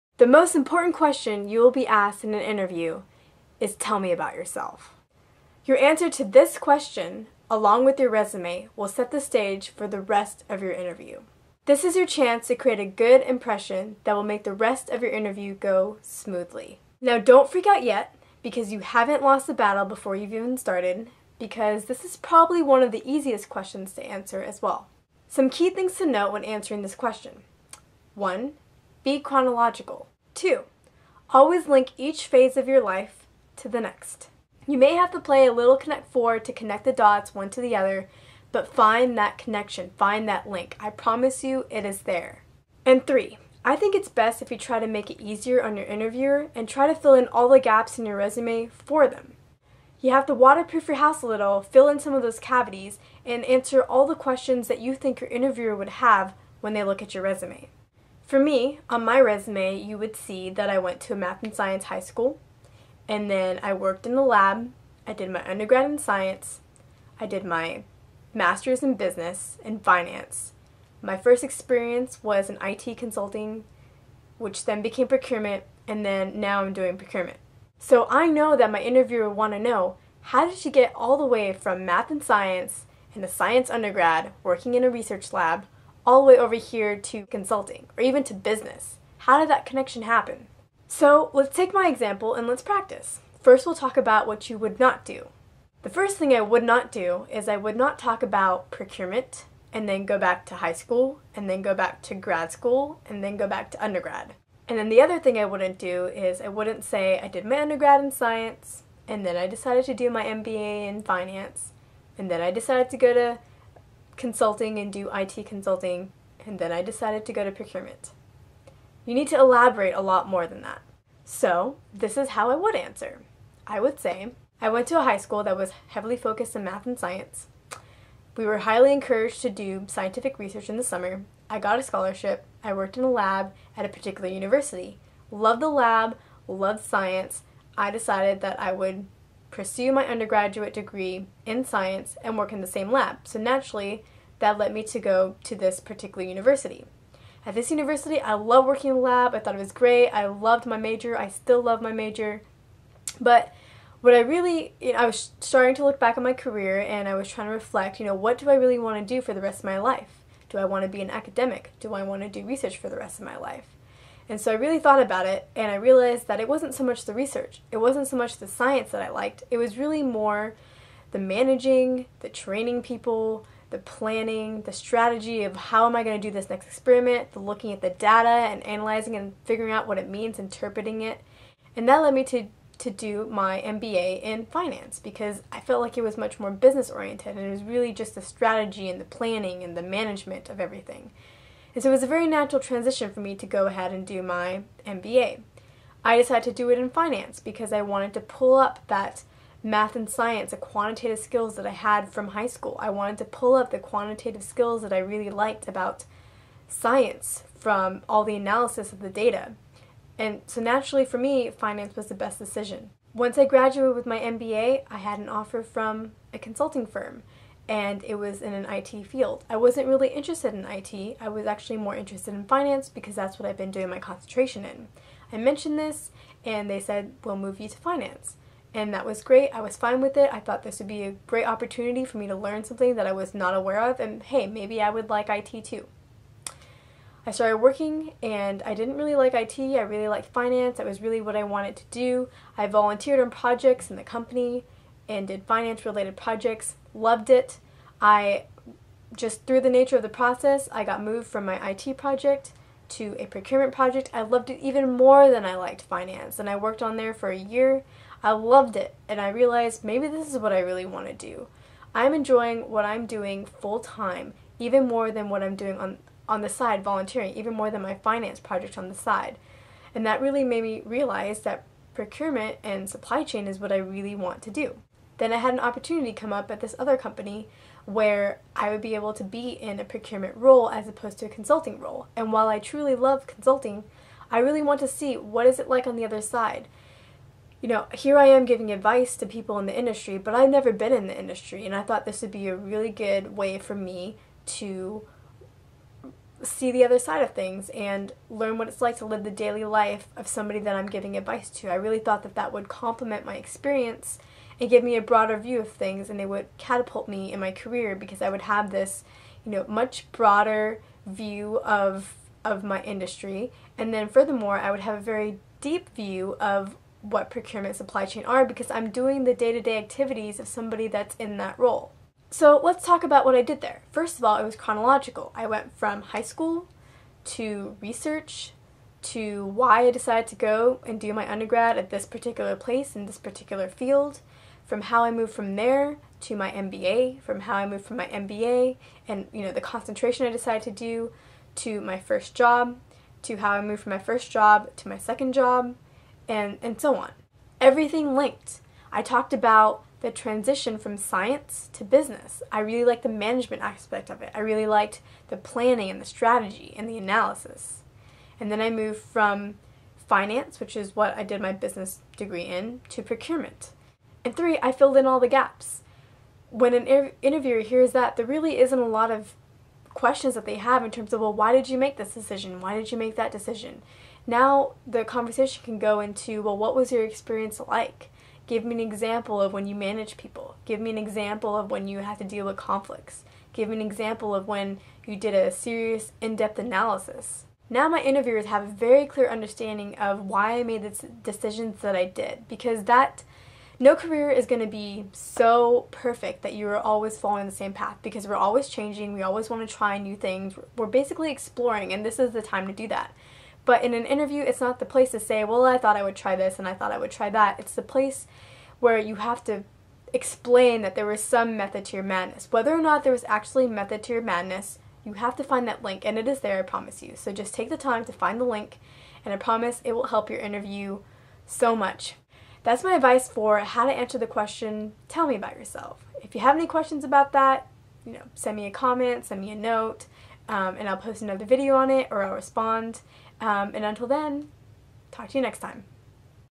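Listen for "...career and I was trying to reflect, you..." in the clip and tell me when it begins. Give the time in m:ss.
2:36.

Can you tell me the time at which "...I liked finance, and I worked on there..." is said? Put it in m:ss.
4:15.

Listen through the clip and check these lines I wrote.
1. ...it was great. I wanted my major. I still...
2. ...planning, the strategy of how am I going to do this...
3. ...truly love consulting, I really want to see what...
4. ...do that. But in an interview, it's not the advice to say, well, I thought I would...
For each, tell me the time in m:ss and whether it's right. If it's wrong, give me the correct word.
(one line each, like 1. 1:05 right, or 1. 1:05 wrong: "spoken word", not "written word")
1. 2:29 wrong: "loved", not "wanted"
2. 2:53 right
3. 4:42 right
4. 6:42 wrong: "place", not "advice".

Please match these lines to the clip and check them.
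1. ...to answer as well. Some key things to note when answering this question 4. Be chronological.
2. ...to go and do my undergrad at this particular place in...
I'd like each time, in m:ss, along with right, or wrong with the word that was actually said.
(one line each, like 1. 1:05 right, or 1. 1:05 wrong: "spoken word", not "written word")
1. 0:23 wrong: "1", not "4"
2. 5:30 right.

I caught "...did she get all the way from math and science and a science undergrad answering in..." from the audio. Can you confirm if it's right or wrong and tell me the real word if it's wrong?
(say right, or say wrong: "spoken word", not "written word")
wrong: "working", not "answering".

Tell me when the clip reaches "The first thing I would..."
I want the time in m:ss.
1:35.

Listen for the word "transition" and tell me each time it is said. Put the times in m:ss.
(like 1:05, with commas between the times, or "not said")
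3:12, 5:50.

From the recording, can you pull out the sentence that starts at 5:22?
So let's talk about what I did there.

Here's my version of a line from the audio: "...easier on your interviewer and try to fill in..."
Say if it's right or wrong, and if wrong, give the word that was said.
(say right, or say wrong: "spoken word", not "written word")
right.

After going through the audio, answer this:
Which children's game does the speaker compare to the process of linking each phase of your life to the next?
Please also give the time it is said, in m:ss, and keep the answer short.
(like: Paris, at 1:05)
Connect four, at 0:35.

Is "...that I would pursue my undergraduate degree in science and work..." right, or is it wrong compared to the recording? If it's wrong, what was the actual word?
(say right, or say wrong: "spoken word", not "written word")
right.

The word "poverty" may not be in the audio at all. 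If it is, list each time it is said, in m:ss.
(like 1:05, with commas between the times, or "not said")
not said.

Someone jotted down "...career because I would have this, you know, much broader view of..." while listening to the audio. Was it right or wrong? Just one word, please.
right.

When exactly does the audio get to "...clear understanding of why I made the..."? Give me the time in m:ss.
6:29.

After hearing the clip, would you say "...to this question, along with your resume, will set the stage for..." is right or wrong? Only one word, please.
right.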